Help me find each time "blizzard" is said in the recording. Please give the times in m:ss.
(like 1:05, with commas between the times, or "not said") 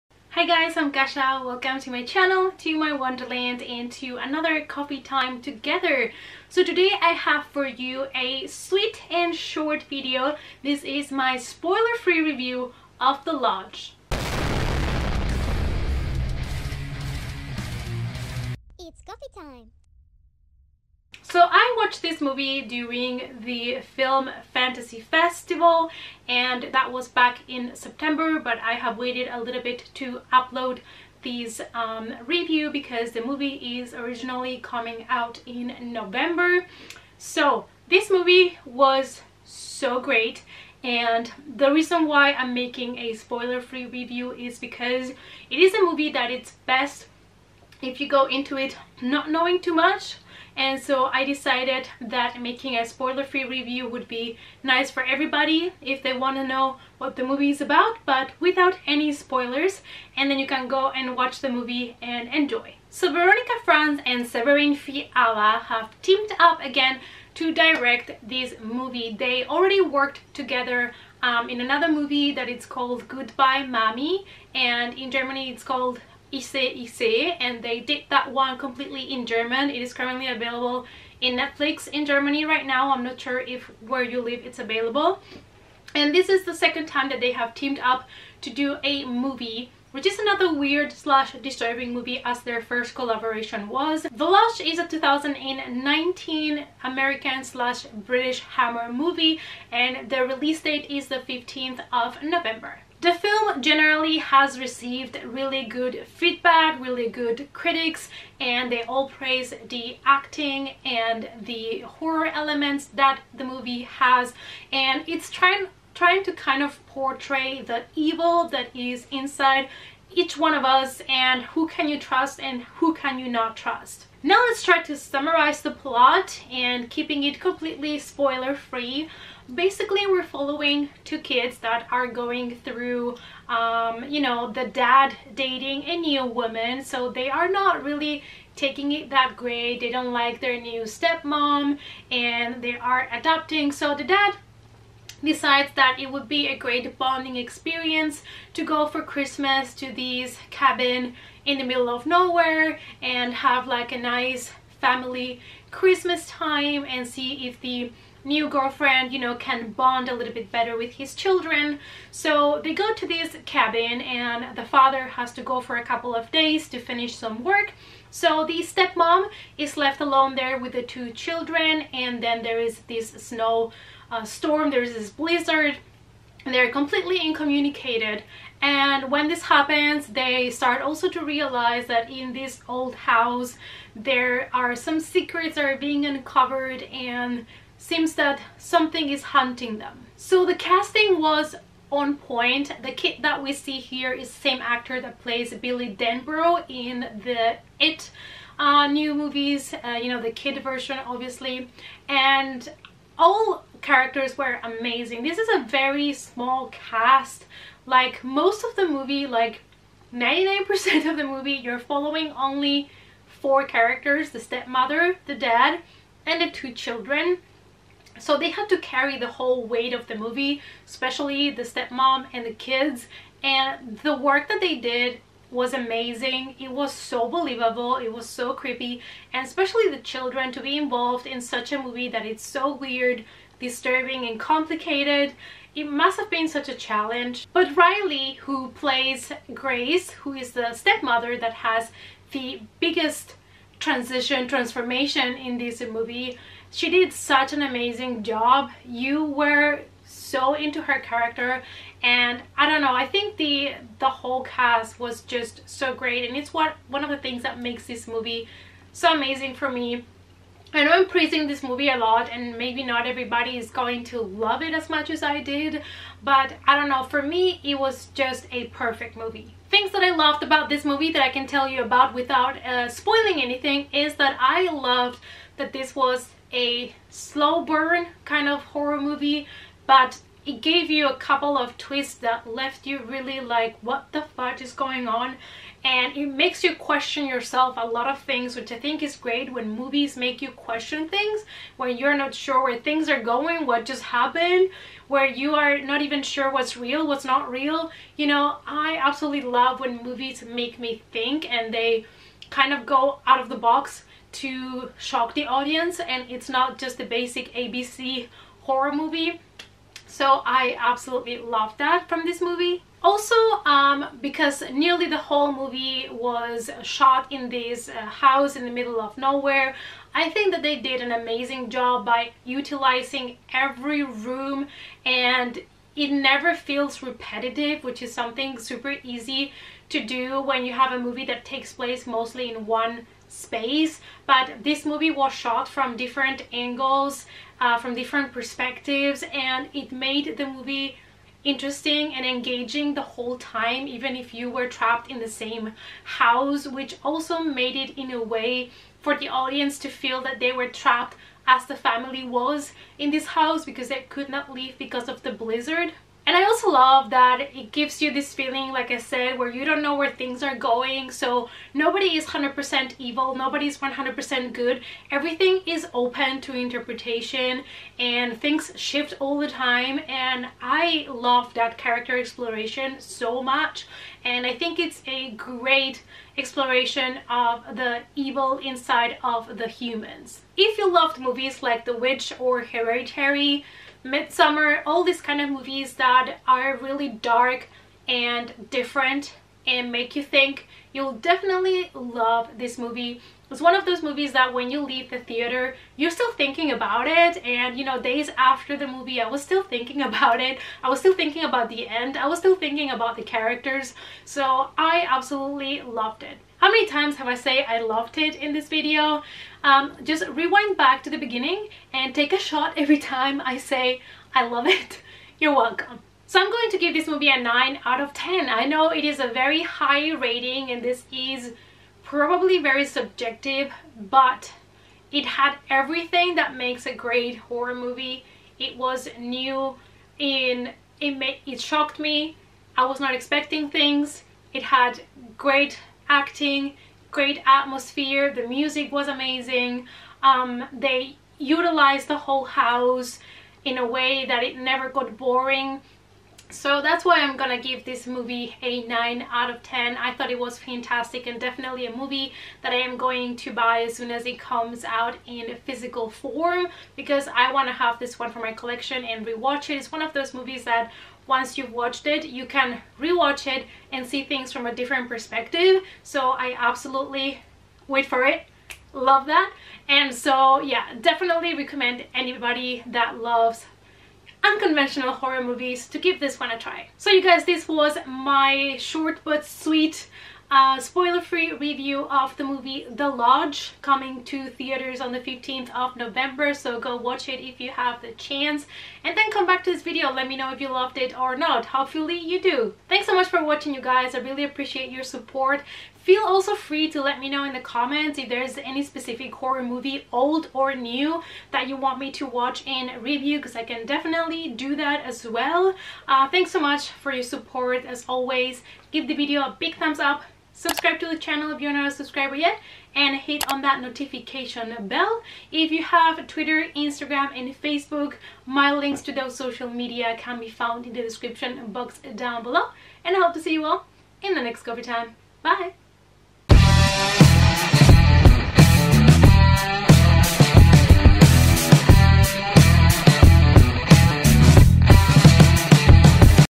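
2:55, 5:55.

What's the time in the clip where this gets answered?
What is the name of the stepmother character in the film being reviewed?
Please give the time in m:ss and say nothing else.
3:59.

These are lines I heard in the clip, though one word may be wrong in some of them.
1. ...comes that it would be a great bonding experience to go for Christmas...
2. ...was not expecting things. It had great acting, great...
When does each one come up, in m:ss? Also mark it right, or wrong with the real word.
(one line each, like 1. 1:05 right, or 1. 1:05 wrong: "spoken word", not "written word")
1. 2:25 wrong: "decides", not "comes"
2. 7:12 right.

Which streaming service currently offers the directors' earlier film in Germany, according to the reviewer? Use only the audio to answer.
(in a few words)
Netflix.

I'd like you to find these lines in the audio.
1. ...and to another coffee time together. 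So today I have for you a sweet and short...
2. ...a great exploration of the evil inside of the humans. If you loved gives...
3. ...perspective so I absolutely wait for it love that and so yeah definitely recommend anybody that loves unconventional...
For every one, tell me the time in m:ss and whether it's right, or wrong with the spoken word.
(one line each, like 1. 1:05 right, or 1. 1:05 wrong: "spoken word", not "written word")
1. 0:03 right
2. 6:15 wrong: "movies", not "gives"
3. 7:45 right.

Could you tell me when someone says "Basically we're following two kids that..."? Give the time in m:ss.
2:09.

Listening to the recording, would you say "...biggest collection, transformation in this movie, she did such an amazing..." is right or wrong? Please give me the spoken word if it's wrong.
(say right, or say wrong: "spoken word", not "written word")
wrong: "transition", not "collection".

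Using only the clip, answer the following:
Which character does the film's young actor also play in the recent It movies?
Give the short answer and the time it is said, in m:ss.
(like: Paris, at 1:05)
Billy Denbrough, at 3:15.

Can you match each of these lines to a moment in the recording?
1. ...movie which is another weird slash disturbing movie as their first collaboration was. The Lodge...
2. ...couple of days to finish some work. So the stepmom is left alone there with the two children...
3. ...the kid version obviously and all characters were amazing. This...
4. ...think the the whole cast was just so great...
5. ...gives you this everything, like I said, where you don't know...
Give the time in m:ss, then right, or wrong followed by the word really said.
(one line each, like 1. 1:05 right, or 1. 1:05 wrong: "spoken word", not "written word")
1. 1:29 right
2. 2:45 right
3. 3:20 right
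4. 4:13 right
5. 5:57 wrong: "feeling", not "everything".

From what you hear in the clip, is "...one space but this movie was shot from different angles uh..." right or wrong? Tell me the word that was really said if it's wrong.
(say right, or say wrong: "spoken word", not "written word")
right.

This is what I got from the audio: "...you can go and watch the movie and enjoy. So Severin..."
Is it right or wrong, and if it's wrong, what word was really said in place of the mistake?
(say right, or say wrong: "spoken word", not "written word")
wrong: "Veronika", not "Severin".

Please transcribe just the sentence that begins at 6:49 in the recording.
Um, just rewind back to the beginning and take a shot every time I say I love it.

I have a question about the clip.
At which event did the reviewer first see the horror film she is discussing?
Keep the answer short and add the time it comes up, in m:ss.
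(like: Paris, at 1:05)
Film Fantasy Festival, at 0:23.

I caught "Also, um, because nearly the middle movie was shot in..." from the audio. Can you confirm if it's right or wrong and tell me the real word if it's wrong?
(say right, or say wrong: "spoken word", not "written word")
wrong: "whole", not "middle".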